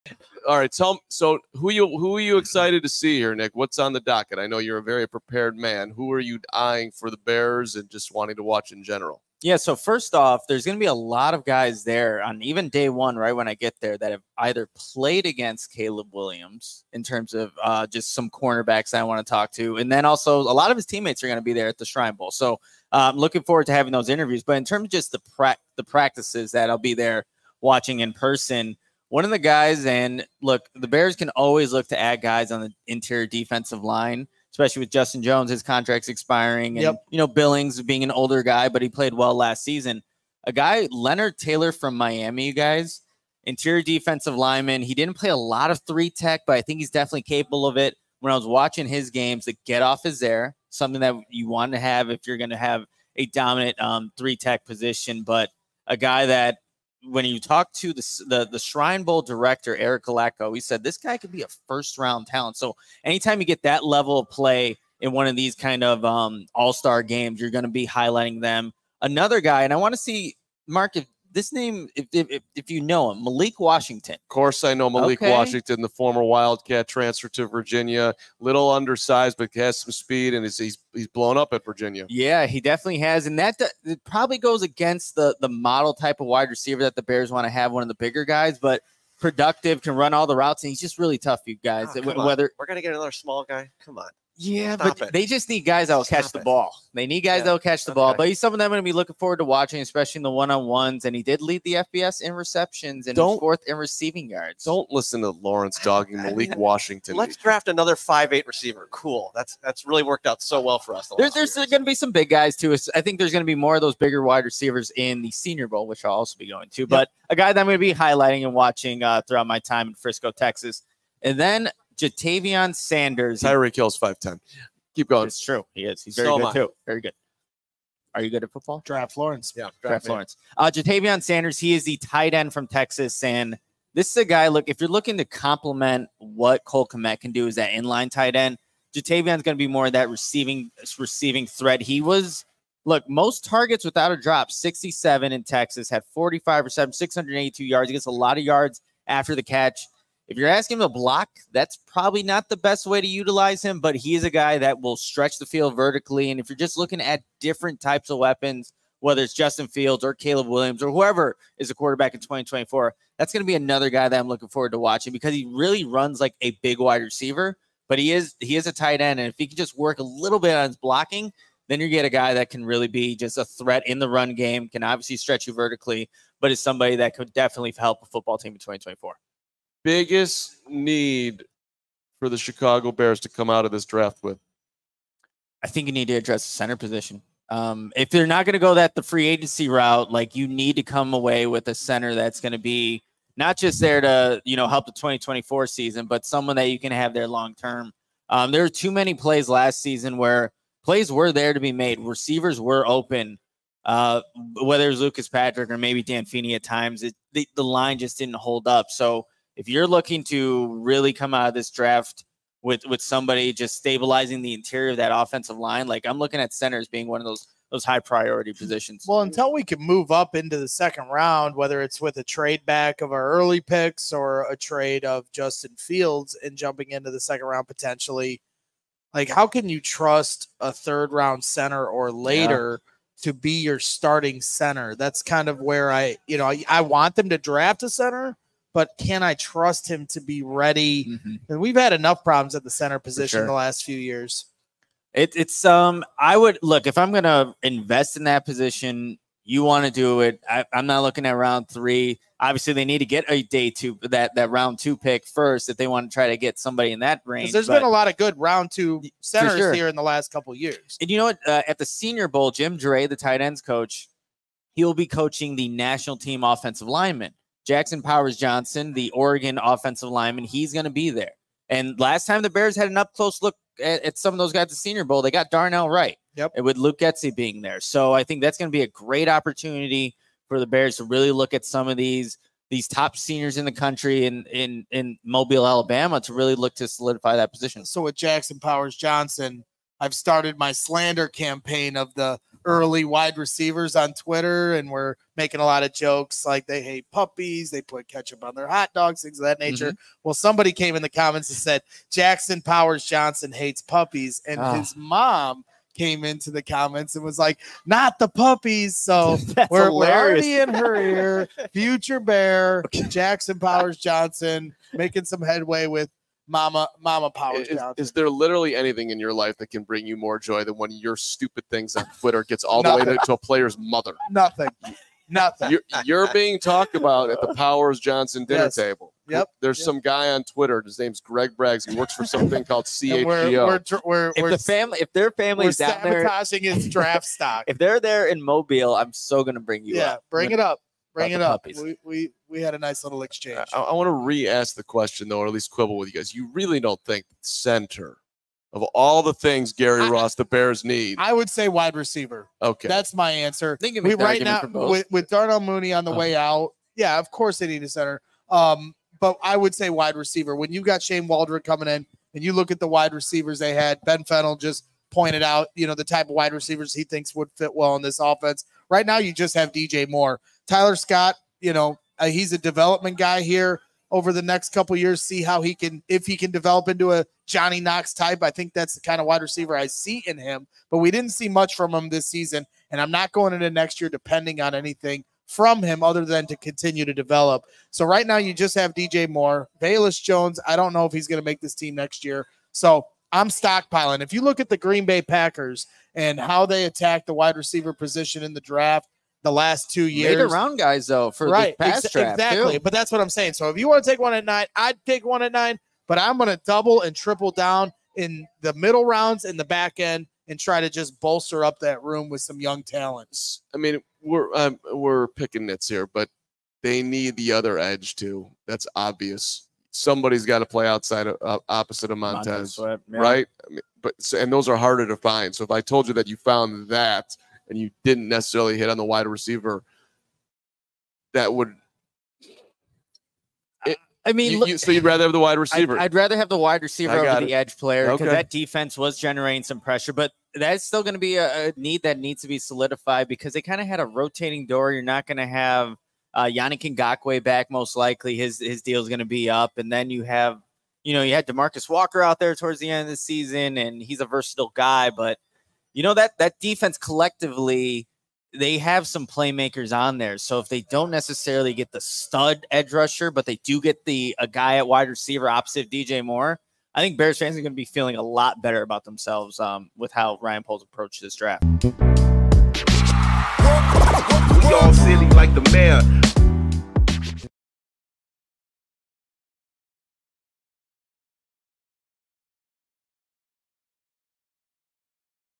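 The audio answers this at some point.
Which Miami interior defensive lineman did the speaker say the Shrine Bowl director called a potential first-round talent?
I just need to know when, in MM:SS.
00:40.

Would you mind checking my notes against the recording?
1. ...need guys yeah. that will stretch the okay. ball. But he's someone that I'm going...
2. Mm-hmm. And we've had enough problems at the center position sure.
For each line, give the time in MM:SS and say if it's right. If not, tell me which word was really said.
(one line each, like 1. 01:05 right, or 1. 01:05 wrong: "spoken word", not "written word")
1. 01:37 wrong: "catch", not "stretch"
2. 04:01 right.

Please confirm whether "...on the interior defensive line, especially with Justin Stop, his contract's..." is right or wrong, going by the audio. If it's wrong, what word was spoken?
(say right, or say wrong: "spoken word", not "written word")
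wrong: "Jones", not "Stop".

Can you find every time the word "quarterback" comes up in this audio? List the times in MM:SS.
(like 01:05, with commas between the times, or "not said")
02:41.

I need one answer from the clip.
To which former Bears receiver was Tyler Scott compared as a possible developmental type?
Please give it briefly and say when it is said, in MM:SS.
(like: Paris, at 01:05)
Johnny Knox, at 06:17.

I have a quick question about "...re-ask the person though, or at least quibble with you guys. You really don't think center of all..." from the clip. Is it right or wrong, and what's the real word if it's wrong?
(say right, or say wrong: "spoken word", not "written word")
wrong: "question", not "person".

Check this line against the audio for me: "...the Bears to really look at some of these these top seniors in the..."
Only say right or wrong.
right.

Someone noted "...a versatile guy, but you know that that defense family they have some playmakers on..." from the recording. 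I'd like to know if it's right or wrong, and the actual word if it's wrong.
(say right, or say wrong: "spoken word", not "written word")
wrong: "collectively", not "family".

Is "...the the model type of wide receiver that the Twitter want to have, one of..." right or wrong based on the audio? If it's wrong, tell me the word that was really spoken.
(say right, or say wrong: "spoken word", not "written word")
wrong: "Bears", not "Twitter".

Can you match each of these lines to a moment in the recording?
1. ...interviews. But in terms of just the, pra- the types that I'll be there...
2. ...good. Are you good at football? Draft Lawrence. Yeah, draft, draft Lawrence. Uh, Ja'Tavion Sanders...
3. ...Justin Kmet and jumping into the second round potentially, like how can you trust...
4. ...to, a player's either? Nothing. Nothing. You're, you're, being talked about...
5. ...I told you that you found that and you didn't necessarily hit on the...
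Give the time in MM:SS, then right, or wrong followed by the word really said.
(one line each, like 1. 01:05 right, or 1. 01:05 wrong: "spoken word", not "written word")
1. 00:24 wrong: "practices", not "types"
2. 02:07 right
3. 03:45 wrong: "Fields", not "Kmet"
4. 05:23 wrong: "mother", not "either"
5. 07:05 right.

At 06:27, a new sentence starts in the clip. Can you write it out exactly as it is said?
So right now you just have DJ Moore, Velus Jones.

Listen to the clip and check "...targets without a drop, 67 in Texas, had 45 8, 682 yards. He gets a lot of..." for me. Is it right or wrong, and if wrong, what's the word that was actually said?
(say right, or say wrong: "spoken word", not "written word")
wrong: "7", not "8".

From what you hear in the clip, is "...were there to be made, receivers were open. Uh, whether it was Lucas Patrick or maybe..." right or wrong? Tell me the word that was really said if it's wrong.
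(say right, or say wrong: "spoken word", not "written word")
right.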